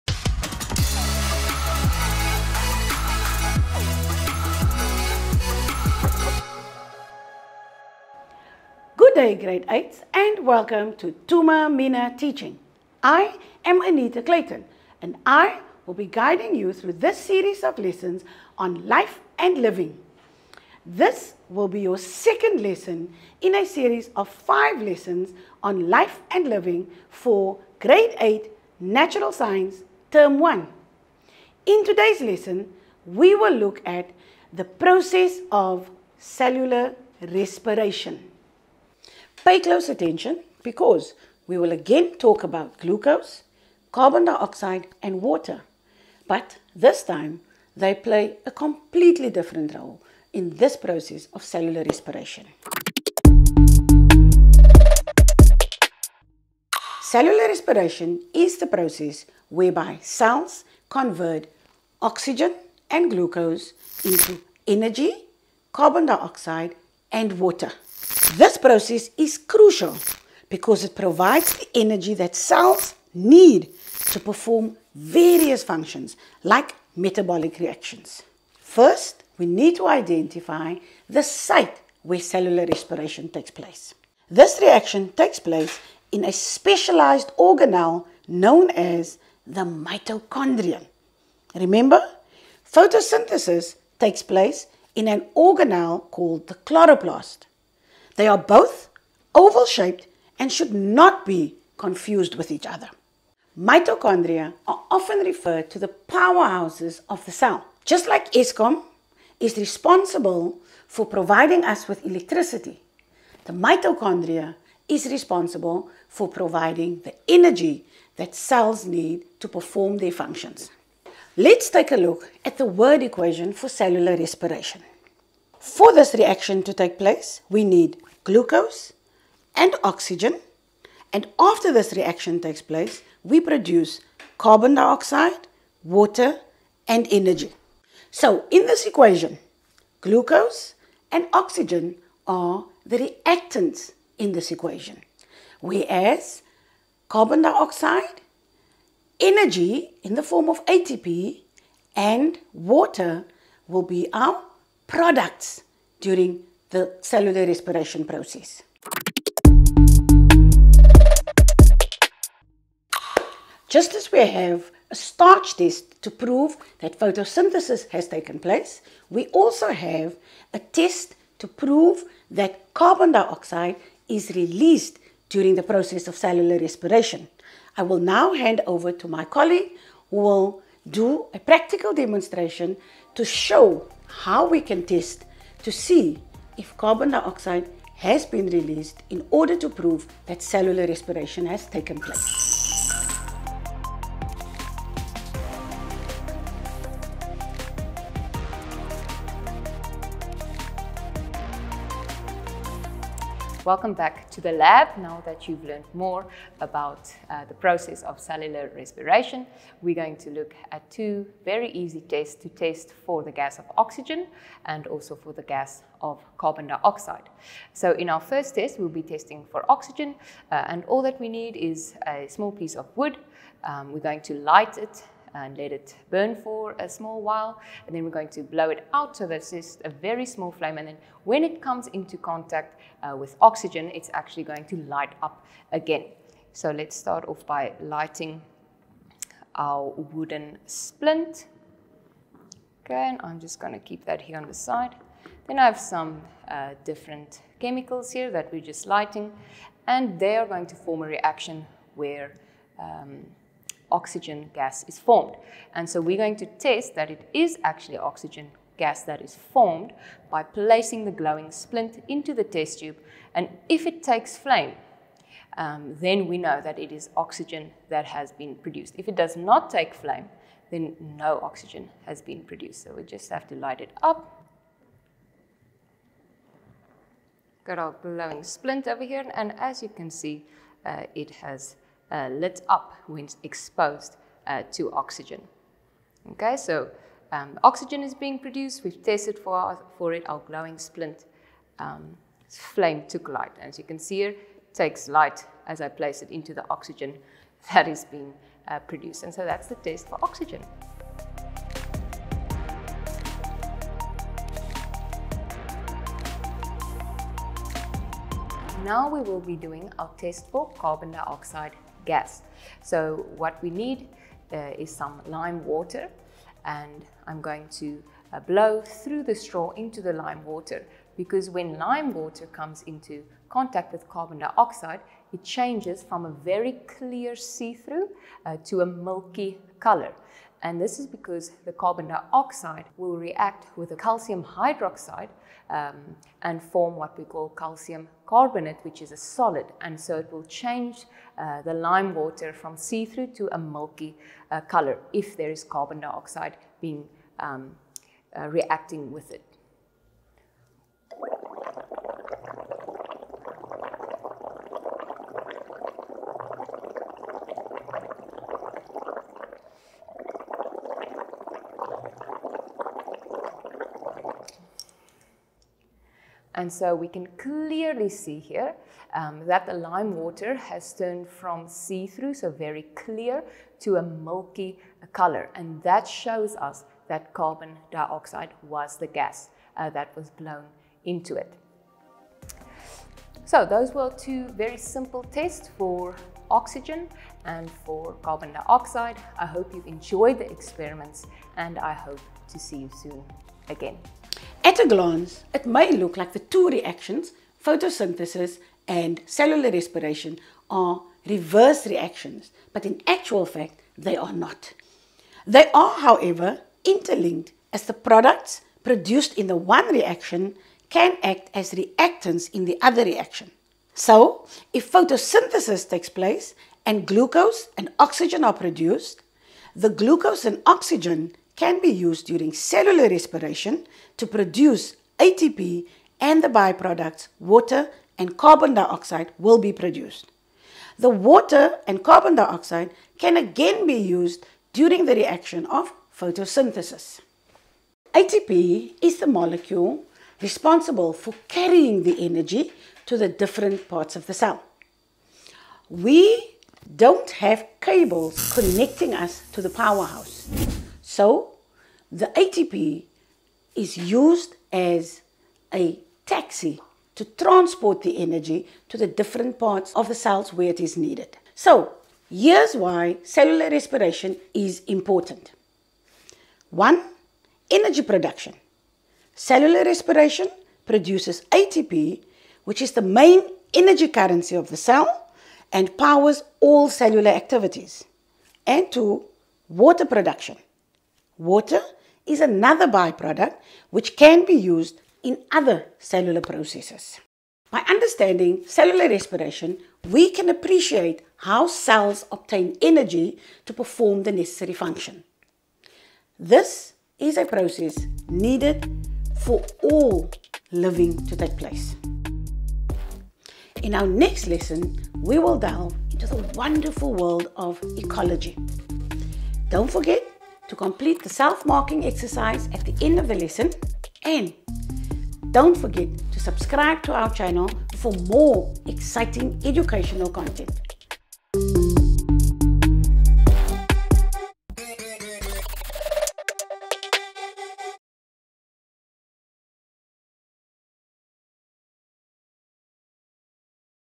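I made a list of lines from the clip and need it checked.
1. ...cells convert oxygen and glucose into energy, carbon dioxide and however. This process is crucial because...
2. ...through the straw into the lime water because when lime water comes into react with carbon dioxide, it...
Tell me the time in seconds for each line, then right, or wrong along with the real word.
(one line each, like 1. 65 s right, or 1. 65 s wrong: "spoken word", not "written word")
1. 60 s wrong: "water", not "however"
2. 318 s wrong: "contact", not "react".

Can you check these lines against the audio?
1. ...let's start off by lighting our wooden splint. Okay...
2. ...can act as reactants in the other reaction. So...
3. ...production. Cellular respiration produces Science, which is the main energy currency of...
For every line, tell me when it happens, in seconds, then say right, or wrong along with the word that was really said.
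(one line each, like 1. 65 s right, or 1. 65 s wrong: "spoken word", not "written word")
1. 236 s right
2. 410 s right
3. 468 s wrong: "ATP", not "Science".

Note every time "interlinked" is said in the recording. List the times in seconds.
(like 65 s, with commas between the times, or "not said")
406 s.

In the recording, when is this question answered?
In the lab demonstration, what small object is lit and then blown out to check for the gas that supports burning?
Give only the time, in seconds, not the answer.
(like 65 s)
222 s.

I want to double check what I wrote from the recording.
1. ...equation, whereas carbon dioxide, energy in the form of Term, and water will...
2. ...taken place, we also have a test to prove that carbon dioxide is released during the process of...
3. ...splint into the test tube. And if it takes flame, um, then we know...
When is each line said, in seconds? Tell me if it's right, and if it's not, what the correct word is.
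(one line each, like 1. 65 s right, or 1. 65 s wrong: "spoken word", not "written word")
1. 144 s wrong: "ATP", not "Term"
2. 168 s right
3. 261 s right.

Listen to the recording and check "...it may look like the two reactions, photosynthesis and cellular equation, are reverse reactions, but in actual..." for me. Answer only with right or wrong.
wrong.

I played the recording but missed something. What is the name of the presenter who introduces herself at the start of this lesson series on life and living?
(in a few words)
Anita Clayton.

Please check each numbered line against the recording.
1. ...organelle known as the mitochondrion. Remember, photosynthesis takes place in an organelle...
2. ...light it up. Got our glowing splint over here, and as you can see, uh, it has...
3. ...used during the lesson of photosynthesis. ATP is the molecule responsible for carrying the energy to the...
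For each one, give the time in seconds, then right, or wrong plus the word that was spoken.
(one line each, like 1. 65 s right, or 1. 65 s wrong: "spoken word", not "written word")
1. 87 s right
2. 273 s right
3. 433 s wrong: "reaction", not "lesson".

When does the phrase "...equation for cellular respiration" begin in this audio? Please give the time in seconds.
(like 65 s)
123 s.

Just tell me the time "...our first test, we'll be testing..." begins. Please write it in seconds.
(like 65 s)
218 s.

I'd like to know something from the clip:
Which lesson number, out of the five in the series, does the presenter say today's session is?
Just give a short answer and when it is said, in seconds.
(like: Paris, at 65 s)
Second, at 21 s.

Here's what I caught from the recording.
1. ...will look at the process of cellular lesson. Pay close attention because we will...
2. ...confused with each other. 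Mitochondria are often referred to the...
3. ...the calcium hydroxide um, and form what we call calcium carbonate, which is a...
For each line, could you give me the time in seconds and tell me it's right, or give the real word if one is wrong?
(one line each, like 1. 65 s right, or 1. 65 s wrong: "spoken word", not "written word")
1. 33 s wrong: "respiration", not "lesson"
2. 101 s right
3. 333 s right.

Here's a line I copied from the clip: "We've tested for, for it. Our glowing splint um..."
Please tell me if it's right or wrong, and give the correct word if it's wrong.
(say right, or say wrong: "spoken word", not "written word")
right.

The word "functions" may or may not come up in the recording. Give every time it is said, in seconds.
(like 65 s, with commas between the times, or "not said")
75 s, 120 s, 494 s.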